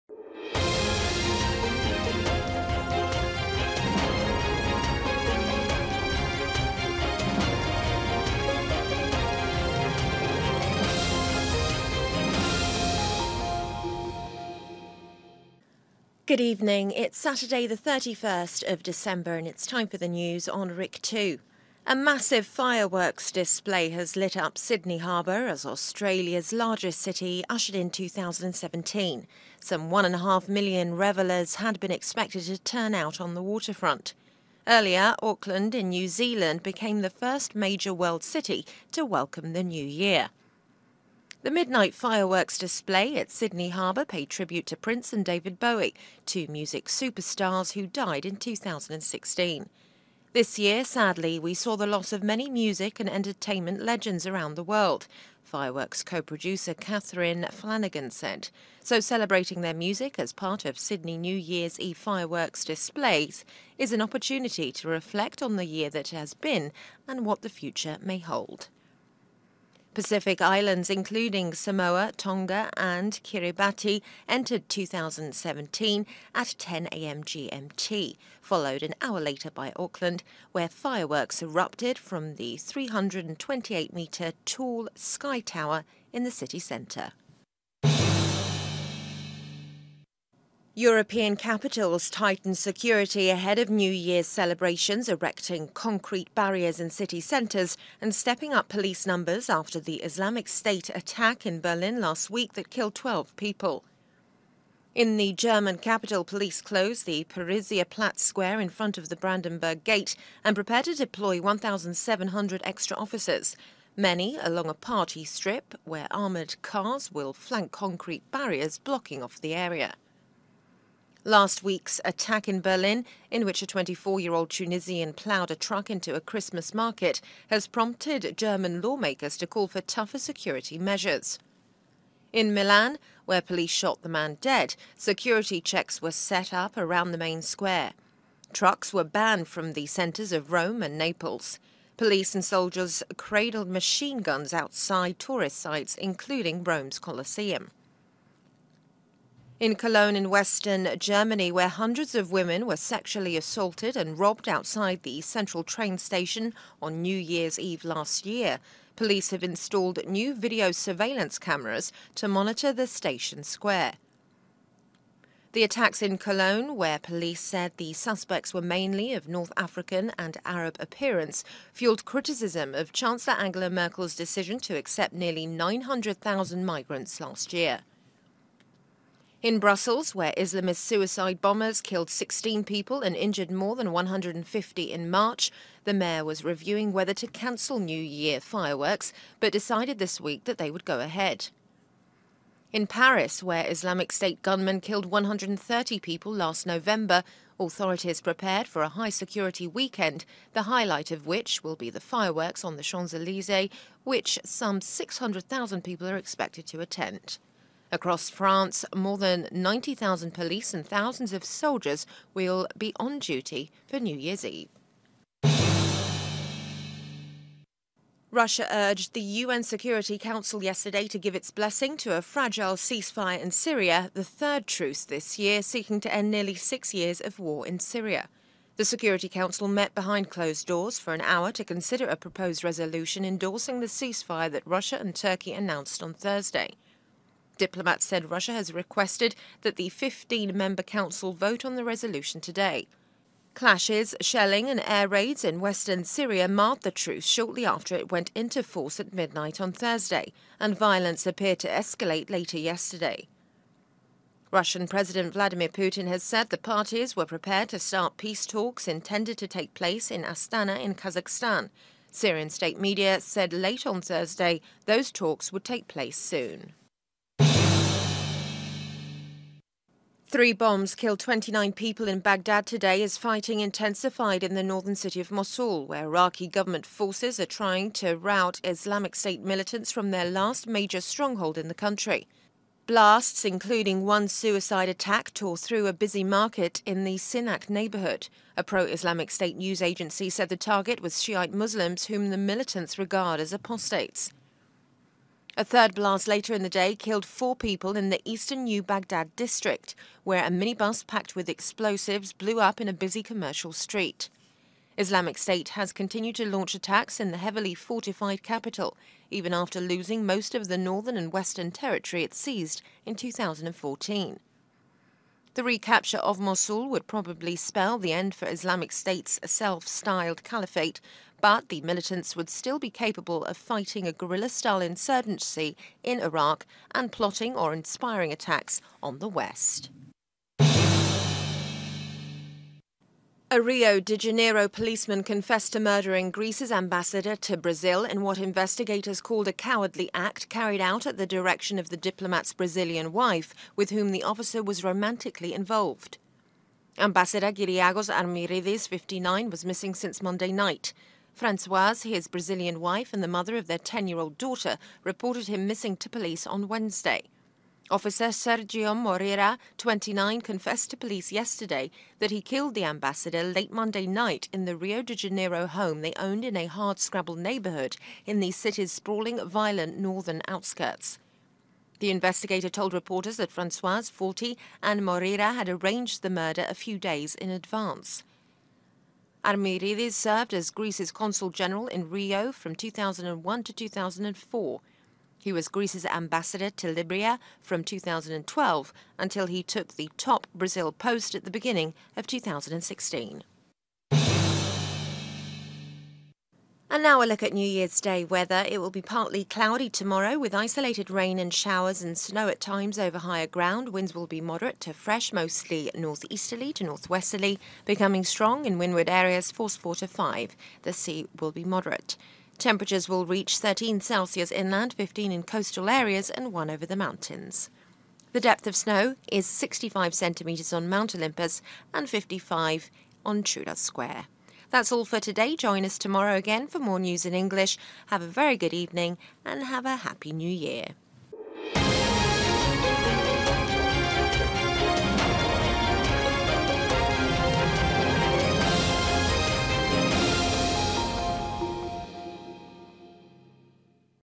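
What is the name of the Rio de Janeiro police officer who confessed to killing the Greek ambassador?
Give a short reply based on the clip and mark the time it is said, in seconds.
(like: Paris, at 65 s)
Sergio Moreira, at 358 s.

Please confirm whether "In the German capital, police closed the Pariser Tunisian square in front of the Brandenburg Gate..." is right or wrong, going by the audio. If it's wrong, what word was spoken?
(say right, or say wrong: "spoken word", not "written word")
wrong: "Platz", not "Tunisian".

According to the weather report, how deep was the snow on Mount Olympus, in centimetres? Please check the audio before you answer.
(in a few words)
65.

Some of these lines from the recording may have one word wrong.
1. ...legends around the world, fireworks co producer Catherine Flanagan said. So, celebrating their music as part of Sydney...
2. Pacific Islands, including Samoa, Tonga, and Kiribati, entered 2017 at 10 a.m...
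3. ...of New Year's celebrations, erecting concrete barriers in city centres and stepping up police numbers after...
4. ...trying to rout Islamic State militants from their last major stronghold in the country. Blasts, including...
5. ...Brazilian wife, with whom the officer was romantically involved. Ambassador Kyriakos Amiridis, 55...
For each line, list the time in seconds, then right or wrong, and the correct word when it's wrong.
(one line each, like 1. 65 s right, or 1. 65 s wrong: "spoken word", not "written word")
1. 53 s right
2. 69 s right
3. 93 s right
4. 277 s right
5. 342 s wrong: "59", not "55".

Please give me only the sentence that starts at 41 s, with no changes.
The midnight fireworks display at Sydney Harbour paid tribute to Prince and David Bowie, two music superstars who died in 2016.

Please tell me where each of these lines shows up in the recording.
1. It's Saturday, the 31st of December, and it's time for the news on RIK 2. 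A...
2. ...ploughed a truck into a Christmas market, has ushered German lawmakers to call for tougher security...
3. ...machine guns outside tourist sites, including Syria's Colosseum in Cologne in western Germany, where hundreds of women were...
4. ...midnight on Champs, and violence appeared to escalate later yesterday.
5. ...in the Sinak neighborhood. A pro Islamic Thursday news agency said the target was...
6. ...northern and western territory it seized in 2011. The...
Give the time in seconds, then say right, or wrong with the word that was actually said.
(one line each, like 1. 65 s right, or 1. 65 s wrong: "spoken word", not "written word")
1. 16 s right
2. 125 s wrong: "prompted", not "ushered"
3. 143 s wrong: "Rome", not "Syria"
4. 249 s wrong: "Thursday", not "Champs"
5. 286 s wrong: "State", not "Thursday"
6. 310 s wrong: "2014", not "2011".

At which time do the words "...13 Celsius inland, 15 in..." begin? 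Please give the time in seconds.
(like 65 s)
413 s.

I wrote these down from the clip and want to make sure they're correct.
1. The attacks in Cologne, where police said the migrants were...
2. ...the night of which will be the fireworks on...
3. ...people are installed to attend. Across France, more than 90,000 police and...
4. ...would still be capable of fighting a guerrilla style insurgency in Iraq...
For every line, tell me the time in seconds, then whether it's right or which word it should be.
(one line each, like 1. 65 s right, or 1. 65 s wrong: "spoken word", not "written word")
1. 165 s wrong: "suspects", not "migrants"
2. 200 s wrong: "highlight", not "night"
3. 205 s wrong: "expected", not "installed"
4. 322 s right.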